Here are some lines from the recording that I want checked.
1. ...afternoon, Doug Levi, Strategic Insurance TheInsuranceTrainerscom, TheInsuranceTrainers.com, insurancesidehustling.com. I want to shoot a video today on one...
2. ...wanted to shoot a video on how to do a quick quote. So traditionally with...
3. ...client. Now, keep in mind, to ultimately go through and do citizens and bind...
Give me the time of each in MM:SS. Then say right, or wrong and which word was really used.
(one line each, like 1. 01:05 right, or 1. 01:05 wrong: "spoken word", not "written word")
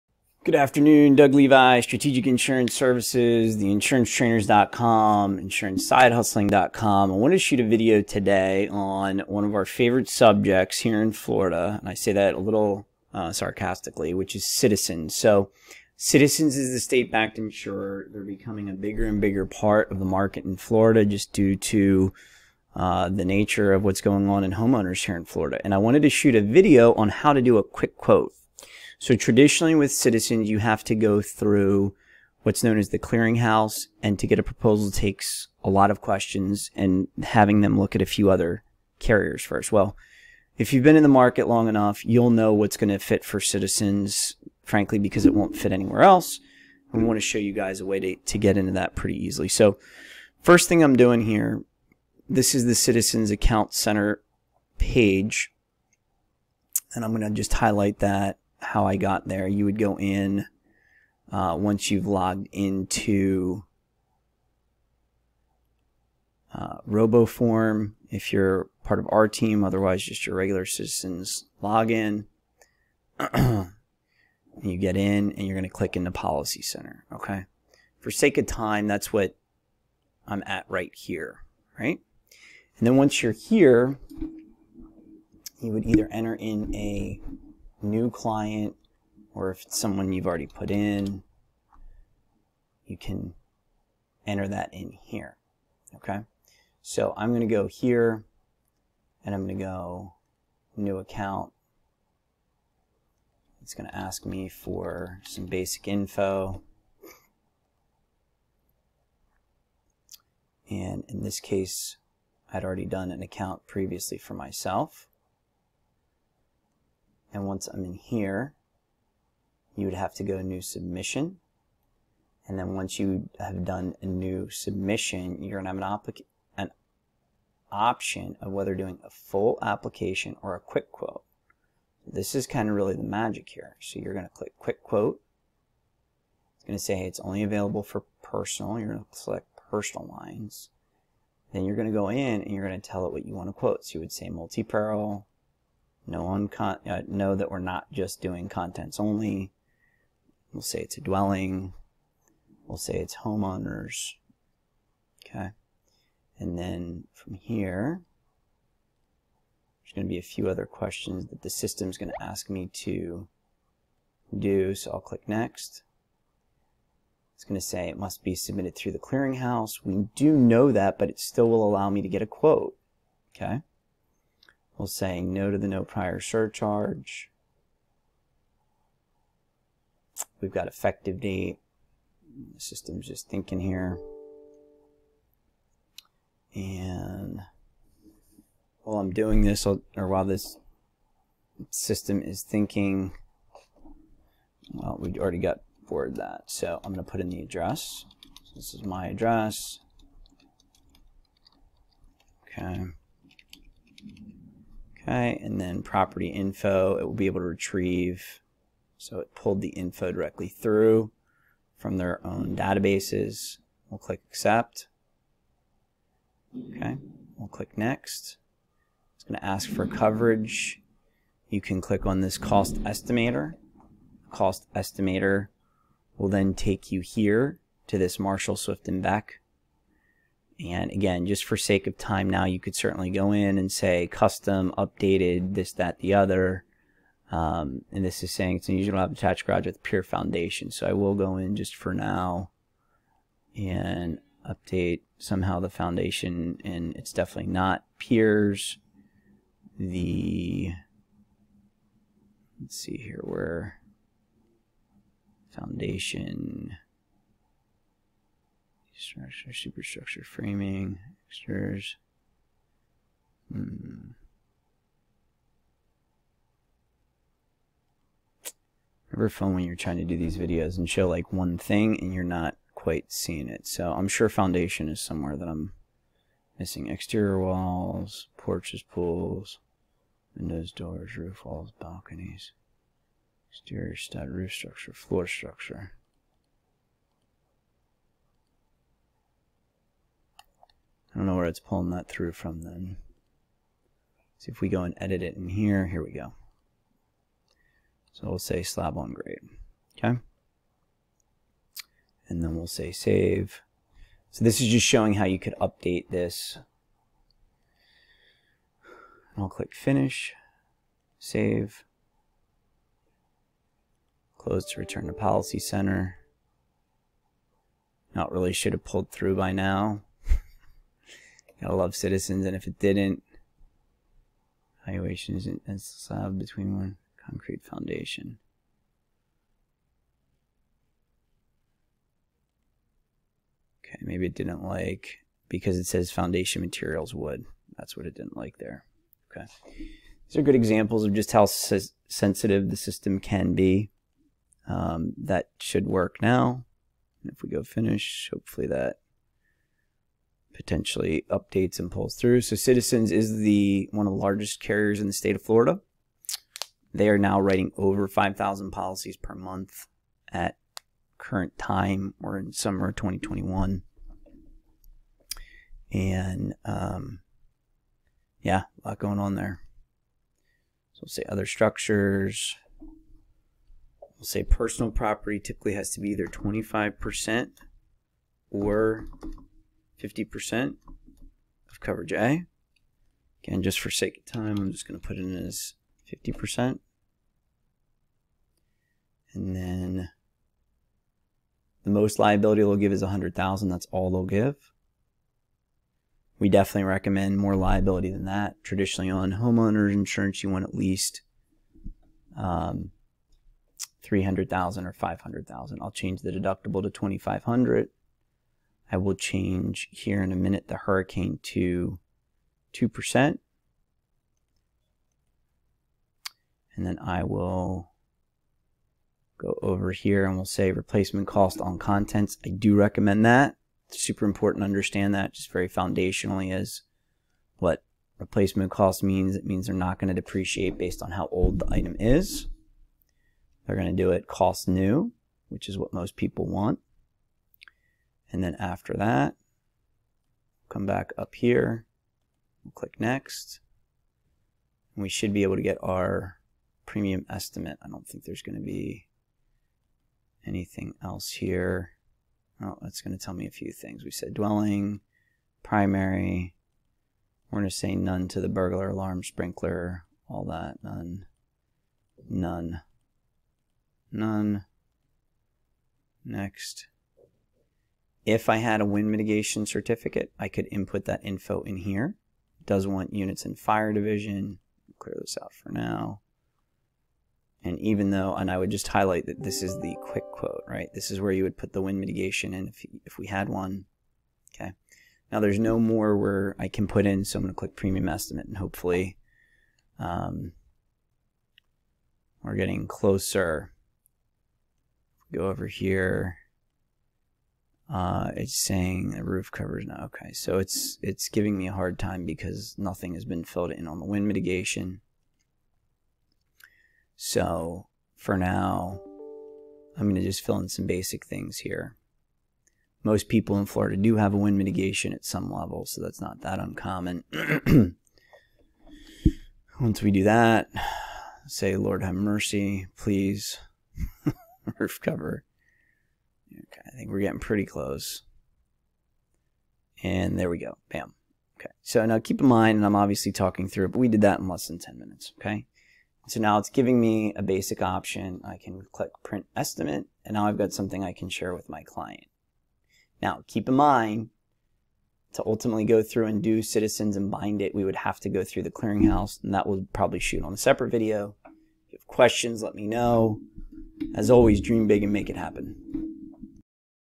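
1. 00:00 wrong: "Services", not "TheInsuranceTrainerscom"
2. 00:25 right
3. 09:01 right.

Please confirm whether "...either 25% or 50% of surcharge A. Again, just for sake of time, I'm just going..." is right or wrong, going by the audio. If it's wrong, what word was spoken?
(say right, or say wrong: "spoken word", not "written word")
wrong: "coverage", not "surcharge".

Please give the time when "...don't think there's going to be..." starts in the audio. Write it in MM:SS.
07:27.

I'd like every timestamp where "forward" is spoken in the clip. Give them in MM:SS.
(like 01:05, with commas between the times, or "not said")
03:15.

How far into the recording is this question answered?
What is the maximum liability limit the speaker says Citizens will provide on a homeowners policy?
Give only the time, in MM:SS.
06:33.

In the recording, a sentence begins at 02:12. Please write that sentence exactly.
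This is kind of really the magic here.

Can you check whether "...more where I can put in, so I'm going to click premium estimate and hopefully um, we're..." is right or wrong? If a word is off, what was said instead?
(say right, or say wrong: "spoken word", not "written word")
right.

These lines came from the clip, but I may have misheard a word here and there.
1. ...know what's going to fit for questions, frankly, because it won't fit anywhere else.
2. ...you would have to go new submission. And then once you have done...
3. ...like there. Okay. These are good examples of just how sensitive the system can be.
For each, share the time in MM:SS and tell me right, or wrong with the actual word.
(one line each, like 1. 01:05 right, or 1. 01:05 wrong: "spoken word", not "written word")
1. 00:42 wrong: "citizens", not "questions"
2. 01:59 right
3. 05:38 right.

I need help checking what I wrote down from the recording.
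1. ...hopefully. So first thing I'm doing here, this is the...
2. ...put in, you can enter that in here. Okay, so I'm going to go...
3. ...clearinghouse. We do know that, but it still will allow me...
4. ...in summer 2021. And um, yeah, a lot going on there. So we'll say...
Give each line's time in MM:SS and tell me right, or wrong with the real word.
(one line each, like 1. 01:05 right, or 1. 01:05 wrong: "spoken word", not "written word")
1. 00:49 wrong: "easily", not "hopefully"
2. 01:30 right
3. 02:48 right
4. 06:02 right.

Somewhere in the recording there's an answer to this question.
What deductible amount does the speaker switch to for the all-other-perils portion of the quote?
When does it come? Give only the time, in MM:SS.
06:46.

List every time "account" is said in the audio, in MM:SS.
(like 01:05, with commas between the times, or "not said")
00:53, 01:40, 01:53.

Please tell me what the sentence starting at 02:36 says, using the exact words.
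And then from here, there's going to be a few other questions that the system's going to ask me to do.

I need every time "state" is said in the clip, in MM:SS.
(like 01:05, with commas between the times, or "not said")
00:16, 05:55.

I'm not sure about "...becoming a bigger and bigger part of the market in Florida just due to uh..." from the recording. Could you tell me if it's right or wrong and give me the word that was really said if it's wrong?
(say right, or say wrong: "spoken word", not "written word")
right.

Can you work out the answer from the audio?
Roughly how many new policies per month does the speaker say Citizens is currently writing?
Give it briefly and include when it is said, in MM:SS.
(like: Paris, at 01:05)
5,000, at 05:58.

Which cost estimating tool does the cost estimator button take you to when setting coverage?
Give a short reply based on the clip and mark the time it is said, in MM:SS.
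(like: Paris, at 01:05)
Marshall, Swift, and Boeckh, at 03:48.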